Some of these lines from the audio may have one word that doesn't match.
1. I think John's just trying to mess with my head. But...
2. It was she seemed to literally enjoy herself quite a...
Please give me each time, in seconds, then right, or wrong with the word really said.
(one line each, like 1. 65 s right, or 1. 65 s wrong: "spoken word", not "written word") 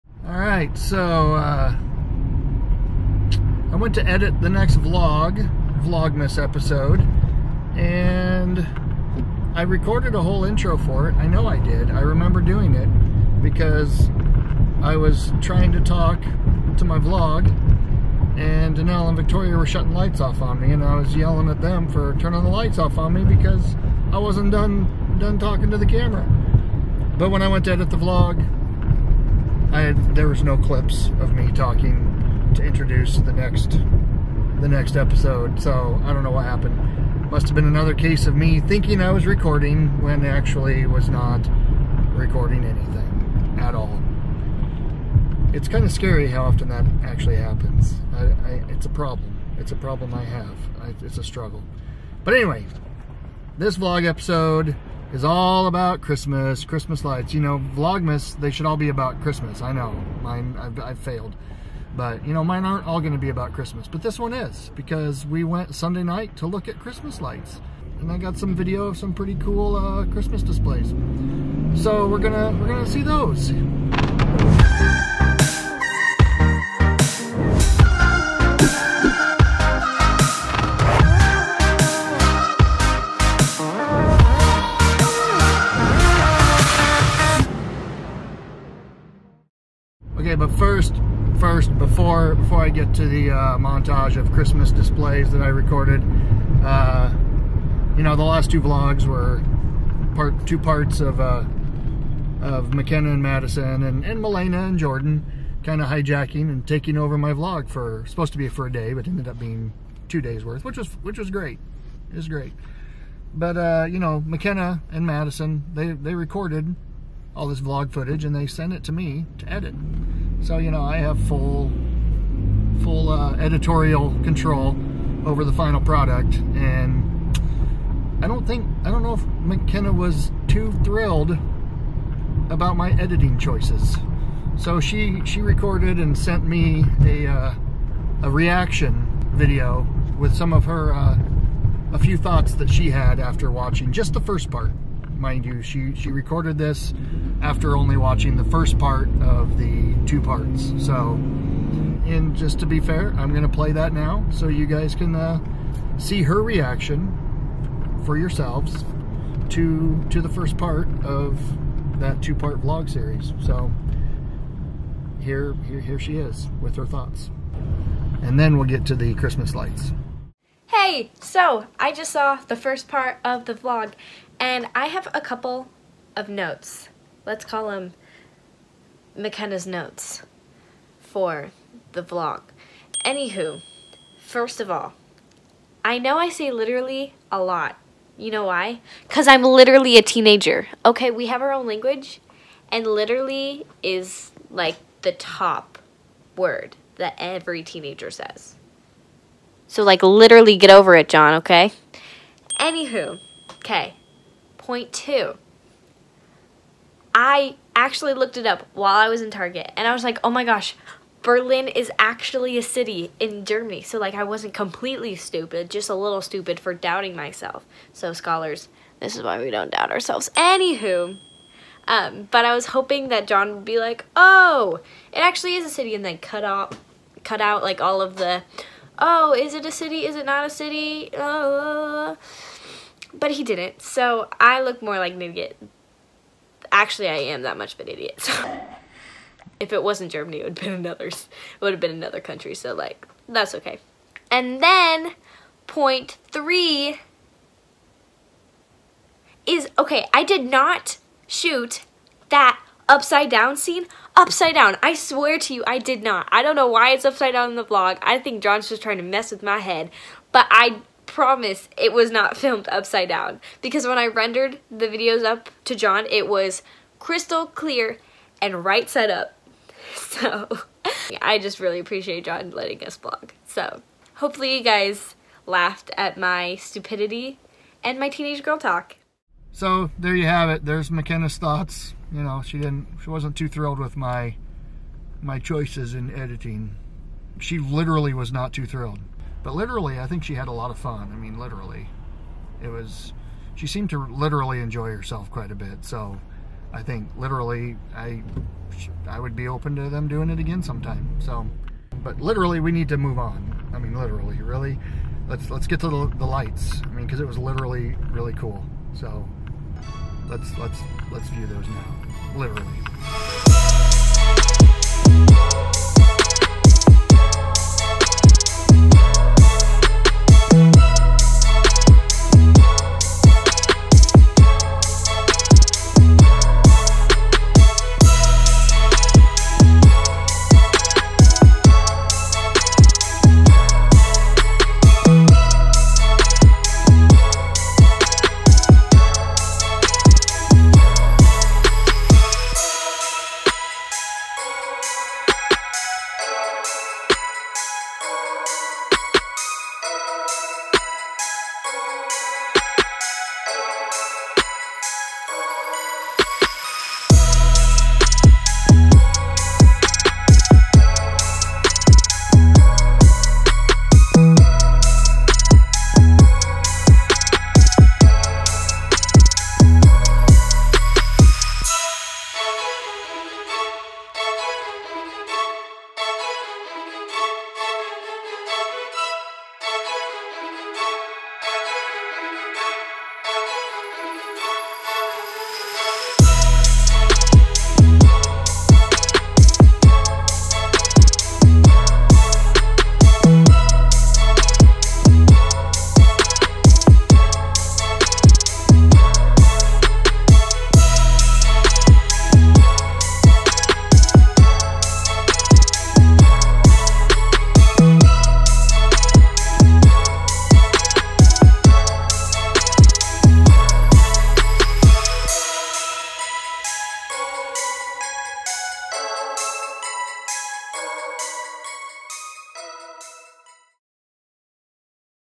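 1. 258 s right
2. 292 s right.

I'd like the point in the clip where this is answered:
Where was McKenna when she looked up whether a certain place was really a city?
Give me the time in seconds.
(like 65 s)
209 s.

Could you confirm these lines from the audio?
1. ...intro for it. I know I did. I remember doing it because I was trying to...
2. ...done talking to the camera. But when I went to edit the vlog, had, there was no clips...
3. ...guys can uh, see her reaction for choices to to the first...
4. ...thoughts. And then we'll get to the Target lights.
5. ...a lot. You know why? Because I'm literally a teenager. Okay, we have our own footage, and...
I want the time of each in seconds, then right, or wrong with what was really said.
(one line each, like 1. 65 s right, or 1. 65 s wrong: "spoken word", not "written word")
1. 10 s right
2. 25 s right
3. 154 s wrong: "yourselves", not "choices"
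4. 166 s wrong: "Christmas", not "Target"
5. 187 s wrong: "language", not "footage".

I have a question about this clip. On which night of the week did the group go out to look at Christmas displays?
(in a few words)
Sunday.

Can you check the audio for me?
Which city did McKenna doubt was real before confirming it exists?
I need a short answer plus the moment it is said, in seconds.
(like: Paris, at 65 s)
Berlin, at 211 s.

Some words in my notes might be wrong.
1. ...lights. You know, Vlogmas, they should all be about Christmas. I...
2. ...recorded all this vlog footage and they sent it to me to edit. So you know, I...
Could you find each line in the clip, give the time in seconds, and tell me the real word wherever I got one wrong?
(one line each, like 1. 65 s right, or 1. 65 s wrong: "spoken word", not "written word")
1. 57 s right
2. 116 s right.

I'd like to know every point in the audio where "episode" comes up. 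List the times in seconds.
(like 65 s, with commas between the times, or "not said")
6 s, 34 s, 54 s.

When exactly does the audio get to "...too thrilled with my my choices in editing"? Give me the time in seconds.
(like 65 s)
283 s.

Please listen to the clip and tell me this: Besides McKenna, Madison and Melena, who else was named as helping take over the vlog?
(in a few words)
Jordan.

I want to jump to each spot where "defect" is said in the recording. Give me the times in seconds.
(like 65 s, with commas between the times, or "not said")
not said.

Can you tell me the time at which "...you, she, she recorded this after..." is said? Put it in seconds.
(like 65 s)
145 s.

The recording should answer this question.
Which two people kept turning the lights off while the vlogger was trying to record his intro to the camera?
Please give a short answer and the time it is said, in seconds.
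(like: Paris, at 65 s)
Denelle and Victoria, at 18 s.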